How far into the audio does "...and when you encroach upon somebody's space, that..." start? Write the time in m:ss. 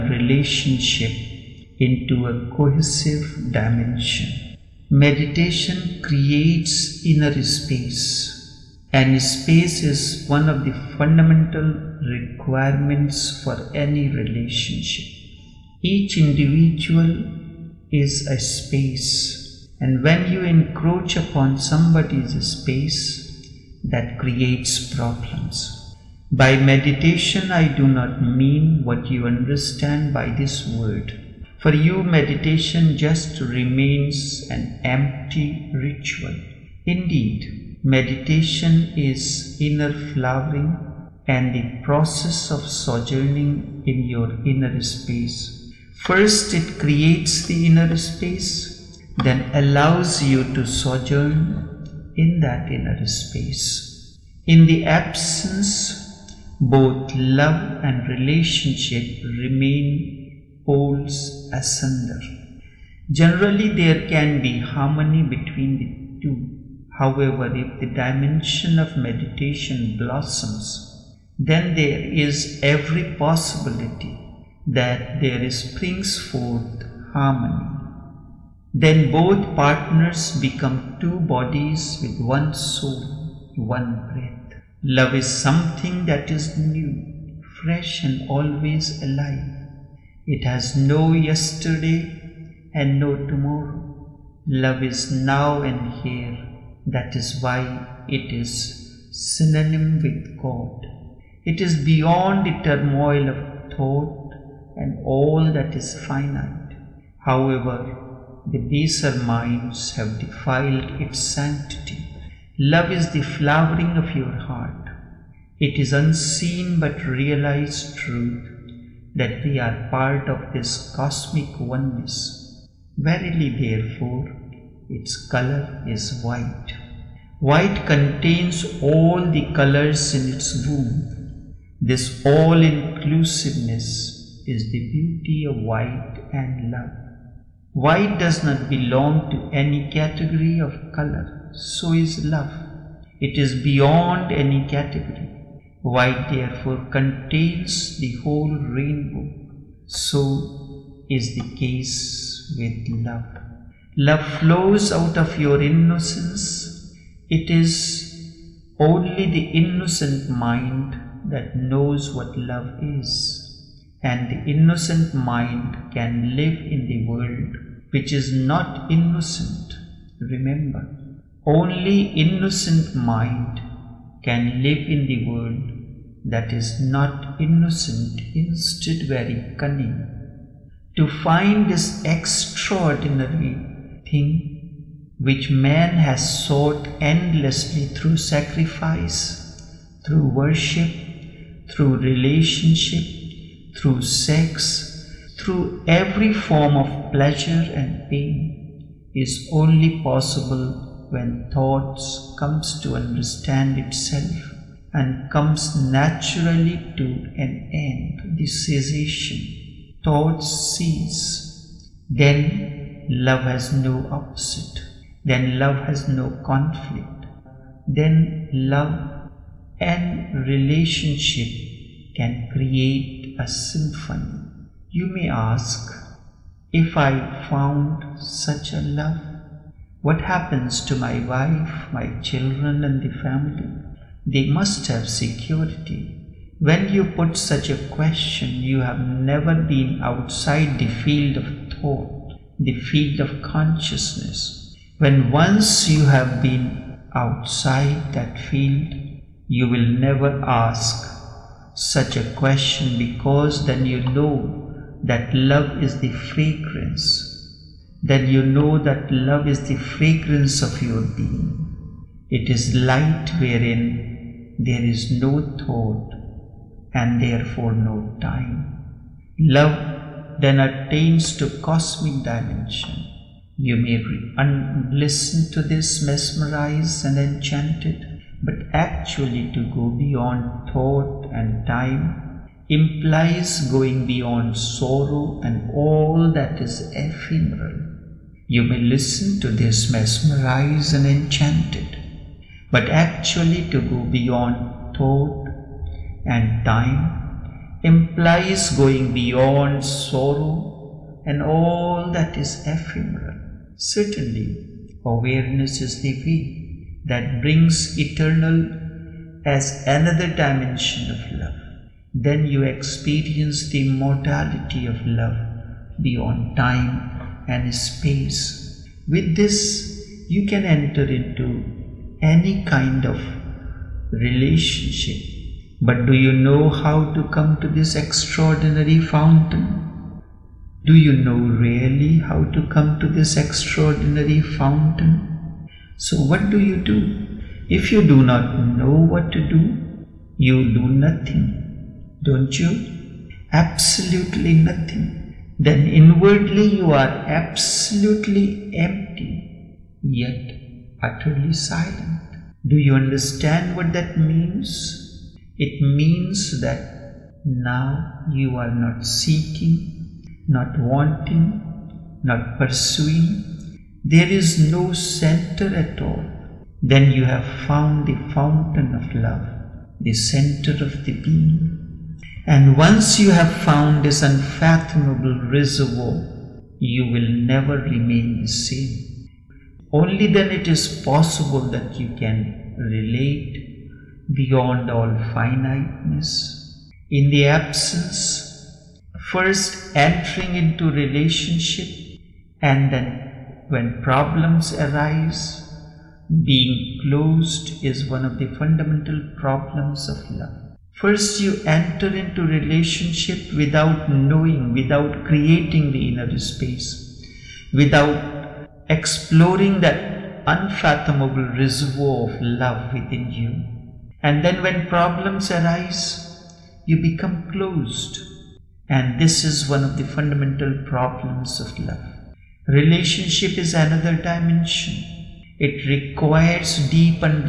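0:19.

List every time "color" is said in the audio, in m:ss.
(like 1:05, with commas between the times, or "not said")
2:05, 2:09, 2:20.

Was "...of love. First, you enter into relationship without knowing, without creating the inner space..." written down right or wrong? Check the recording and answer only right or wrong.
right.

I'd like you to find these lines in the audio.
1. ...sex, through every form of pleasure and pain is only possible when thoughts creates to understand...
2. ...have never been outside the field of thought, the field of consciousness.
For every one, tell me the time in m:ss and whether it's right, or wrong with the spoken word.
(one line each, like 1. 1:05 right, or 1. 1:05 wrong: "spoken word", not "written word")
1. 3:14 wrong: "comes", not "creates"
2. 3:58 right.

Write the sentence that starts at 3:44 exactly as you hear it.
You may ask, if I found such a love, what happens to my wife, my children, and the family?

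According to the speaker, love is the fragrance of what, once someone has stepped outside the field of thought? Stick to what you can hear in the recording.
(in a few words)
Your being.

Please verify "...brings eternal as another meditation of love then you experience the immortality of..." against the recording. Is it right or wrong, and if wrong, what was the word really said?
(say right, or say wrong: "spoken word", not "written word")
wrong: "dimension", not "meditation".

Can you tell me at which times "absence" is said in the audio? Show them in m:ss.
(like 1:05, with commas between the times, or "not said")
0:54, 6:27.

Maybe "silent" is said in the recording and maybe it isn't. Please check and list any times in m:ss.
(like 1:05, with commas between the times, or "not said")
5:51.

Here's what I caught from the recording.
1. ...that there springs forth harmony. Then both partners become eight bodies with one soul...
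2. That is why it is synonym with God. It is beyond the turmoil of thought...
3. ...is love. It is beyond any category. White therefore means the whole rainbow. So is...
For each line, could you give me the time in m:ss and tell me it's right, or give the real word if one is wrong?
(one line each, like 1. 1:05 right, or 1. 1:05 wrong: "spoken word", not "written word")
1. 1:14 wrong: "two", not "eight"
2. 1:36 right
3. 2:21 wrong: "contains", not "means".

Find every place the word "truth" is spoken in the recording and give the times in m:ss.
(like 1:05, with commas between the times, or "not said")
1:57.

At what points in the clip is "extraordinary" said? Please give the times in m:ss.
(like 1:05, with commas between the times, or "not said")
3:02, 5:27, 5:33.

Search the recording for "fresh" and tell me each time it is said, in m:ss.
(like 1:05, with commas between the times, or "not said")
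1:27.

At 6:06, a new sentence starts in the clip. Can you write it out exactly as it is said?
Then you have found the fountain of love, the center of the being.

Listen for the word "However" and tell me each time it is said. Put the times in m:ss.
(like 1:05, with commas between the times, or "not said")
1:06, 1:47.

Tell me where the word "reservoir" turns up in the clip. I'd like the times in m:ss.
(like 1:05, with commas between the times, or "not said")
6:15, 6:51.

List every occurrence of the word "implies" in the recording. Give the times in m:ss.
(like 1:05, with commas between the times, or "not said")
4:42, 4:57.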